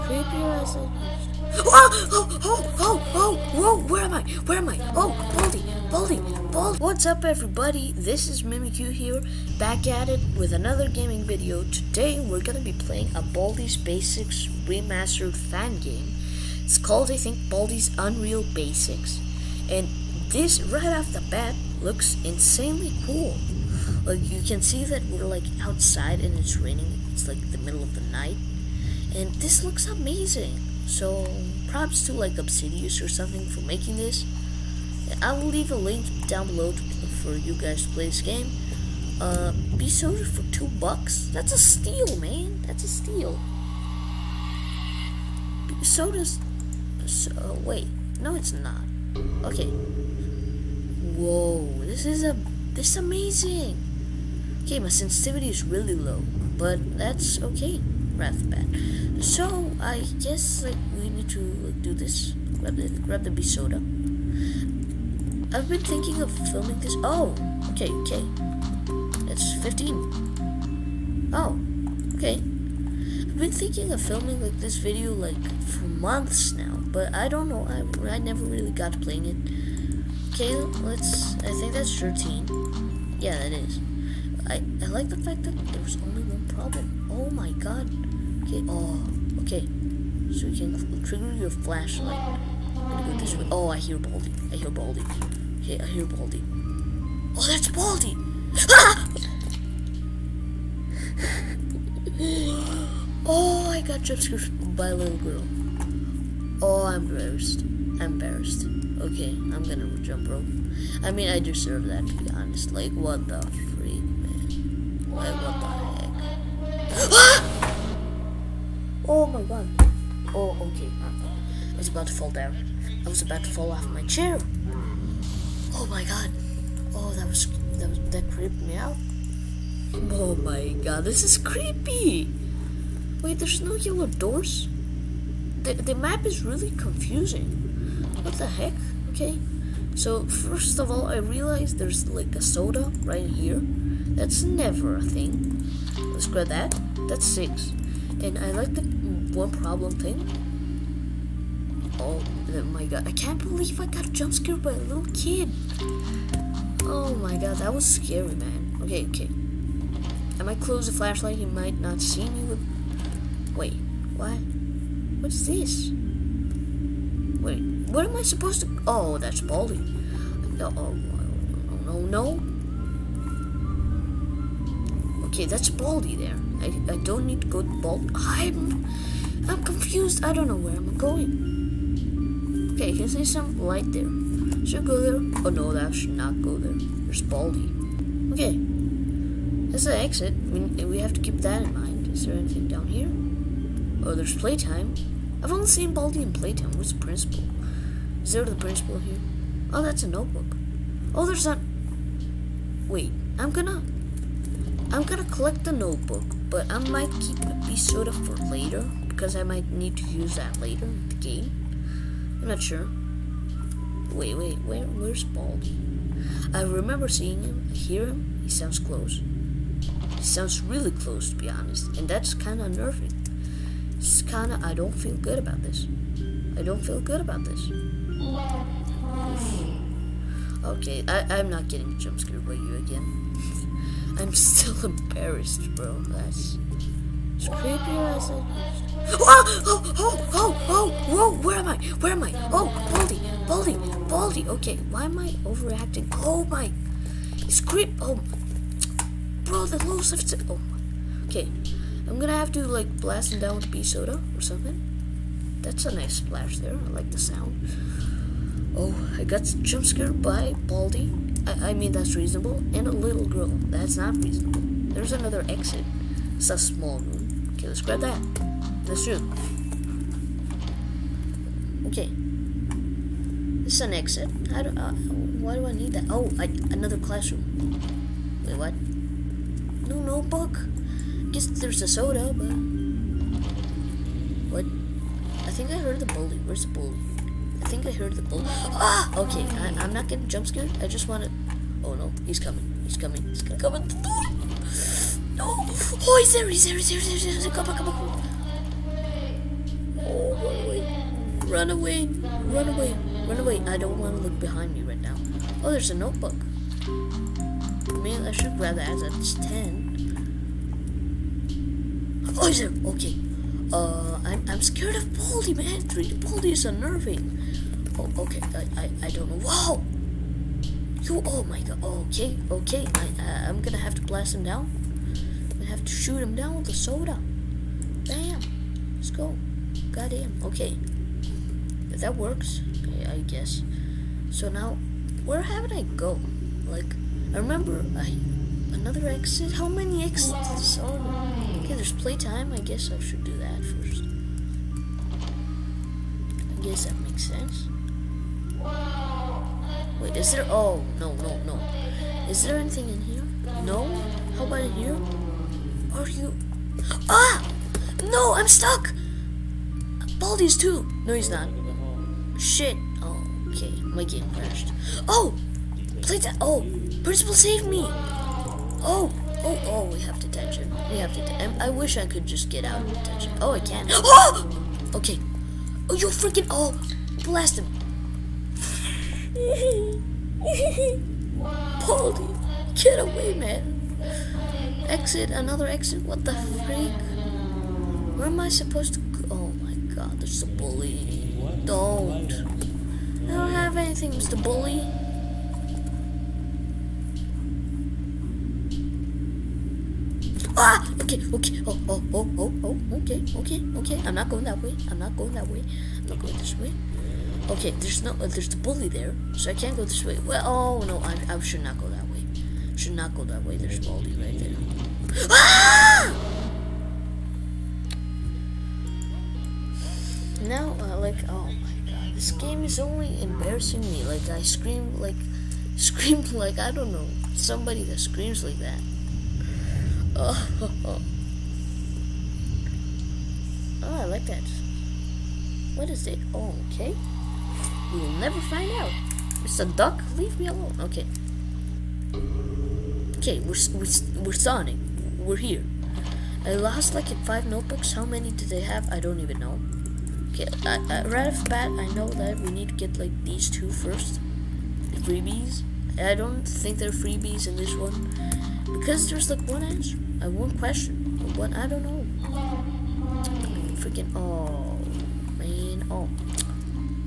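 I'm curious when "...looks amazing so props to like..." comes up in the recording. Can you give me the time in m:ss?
0:29.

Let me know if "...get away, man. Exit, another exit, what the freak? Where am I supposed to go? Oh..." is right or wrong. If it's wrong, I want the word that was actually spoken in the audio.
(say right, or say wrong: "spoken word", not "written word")
right.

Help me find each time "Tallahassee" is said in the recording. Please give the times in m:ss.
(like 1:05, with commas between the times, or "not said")
not said.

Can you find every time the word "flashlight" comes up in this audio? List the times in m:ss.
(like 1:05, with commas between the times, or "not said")
1:31, 2:40.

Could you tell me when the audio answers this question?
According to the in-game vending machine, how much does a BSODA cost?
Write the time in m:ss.
0:40.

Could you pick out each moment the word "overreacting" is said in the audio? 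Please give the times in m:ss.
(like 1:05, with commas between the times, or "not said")
4:05.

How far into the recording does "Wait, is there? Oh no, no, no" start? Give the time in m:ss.
5:50.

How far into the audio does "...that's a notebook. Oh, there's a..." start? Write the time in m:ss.
3:19.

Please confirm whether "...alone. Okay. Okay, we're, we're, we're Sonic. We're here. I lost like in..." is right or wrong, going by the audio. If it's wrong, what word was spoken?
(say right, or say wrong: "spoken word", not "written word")
right.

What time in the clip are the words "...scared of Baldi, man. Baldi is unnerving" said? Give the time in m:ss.
5:14.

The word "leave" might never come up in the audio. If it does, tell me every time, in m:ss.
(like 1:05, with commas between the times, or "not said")
0:35, 7:20.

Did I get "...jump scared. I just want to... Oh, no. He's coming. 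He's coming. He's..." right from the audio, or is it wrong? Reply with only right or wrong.
right.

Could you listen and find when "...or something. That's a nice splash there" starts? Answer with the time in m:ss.
4:14.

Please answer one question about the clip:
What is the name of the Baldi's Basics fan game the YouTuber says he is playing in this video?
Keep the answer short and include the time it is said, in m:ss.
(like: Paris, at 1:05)
Baldi's Unreal Basics, at 0:17.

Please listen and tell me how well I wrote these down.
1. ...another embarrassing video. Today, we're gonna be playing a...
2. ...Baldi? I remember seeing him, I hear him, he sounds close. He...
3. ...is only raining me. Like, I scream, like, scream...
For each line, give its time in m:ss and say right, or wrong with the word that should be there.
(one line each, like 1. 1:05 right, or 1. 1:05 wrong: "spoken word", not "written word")
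1. 0:10 wrong: "gaming", not "embarrassing"
2. 3:35 right
3. 7:02 wrong: "embarrassing", not "raining".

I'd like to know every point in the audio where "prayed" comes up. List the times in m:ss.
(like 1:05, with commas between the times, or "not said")
not said.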